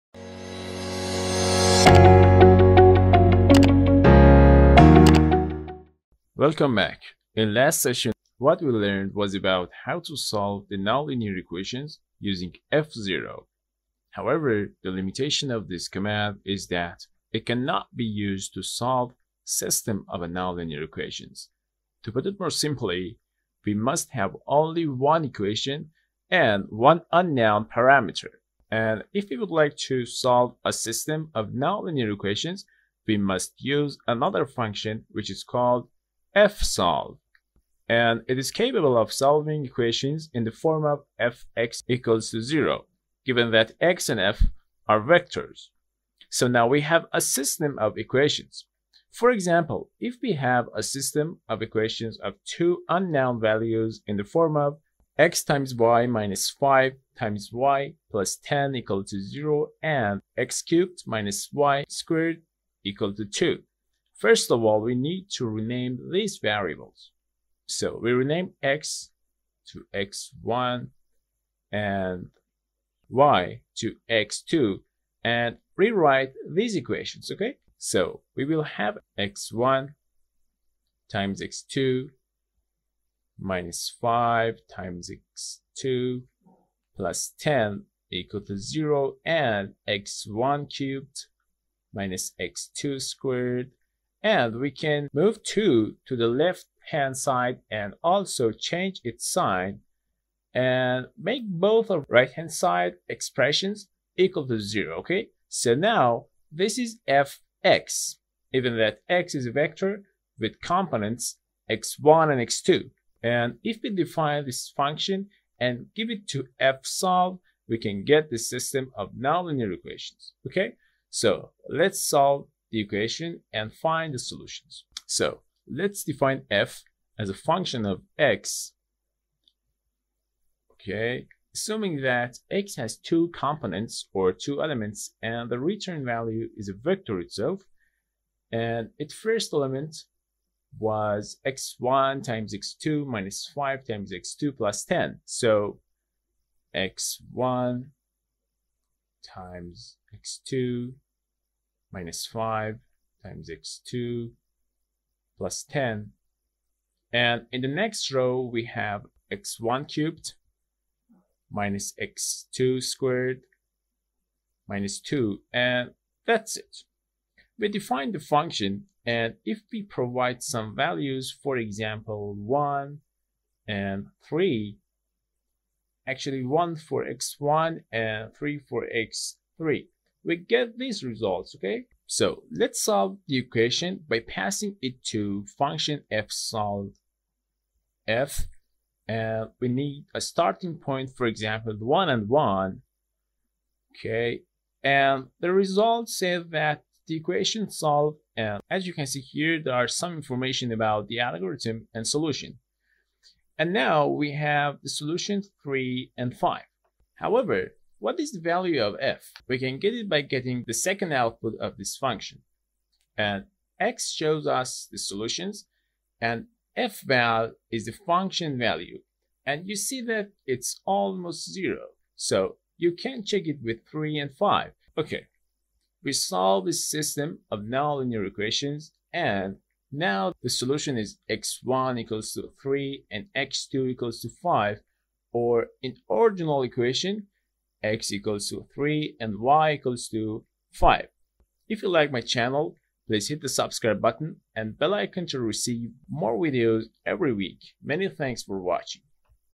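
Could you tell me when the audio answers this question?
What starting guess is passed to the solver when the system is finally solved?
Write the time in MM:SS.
03:11.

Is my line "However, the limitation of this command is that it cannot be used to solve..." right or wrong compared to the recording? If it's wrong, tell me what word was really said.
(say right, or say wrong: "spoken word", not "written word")
right.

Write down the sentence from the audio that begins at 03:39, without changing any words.
And you see that it's almost zero.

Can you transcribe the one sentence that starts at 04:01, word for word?
If you like my channel, please hit the subscribe button and bell icon to receive more videos every week.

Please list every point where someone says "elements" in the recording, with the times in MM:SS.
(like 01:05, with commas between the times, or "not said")
02:14, 02:19.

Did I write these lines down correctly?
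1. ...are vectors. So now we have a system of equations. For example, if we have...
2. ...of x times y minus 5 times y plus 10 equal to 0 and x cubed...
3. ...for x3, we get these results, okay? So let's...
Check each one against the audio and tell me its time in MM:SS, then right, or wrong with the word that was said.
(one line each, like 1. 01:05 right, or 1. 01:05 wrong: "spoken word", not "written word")
1. 00:44 right
2. 00:54 right
3. 02:58 right.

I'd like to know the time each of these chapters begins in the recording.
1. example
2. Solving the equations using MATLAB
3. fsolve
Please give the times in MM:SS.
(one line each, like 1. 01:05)
1. 00:48
2. 02:04
3. 00:30.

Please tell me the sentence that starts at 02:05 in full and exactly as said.
So let's define f as a function of x.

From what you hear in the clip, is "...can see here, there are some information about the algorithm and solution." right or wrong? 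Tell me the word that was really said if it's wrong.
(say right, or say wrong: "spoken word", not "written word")
right.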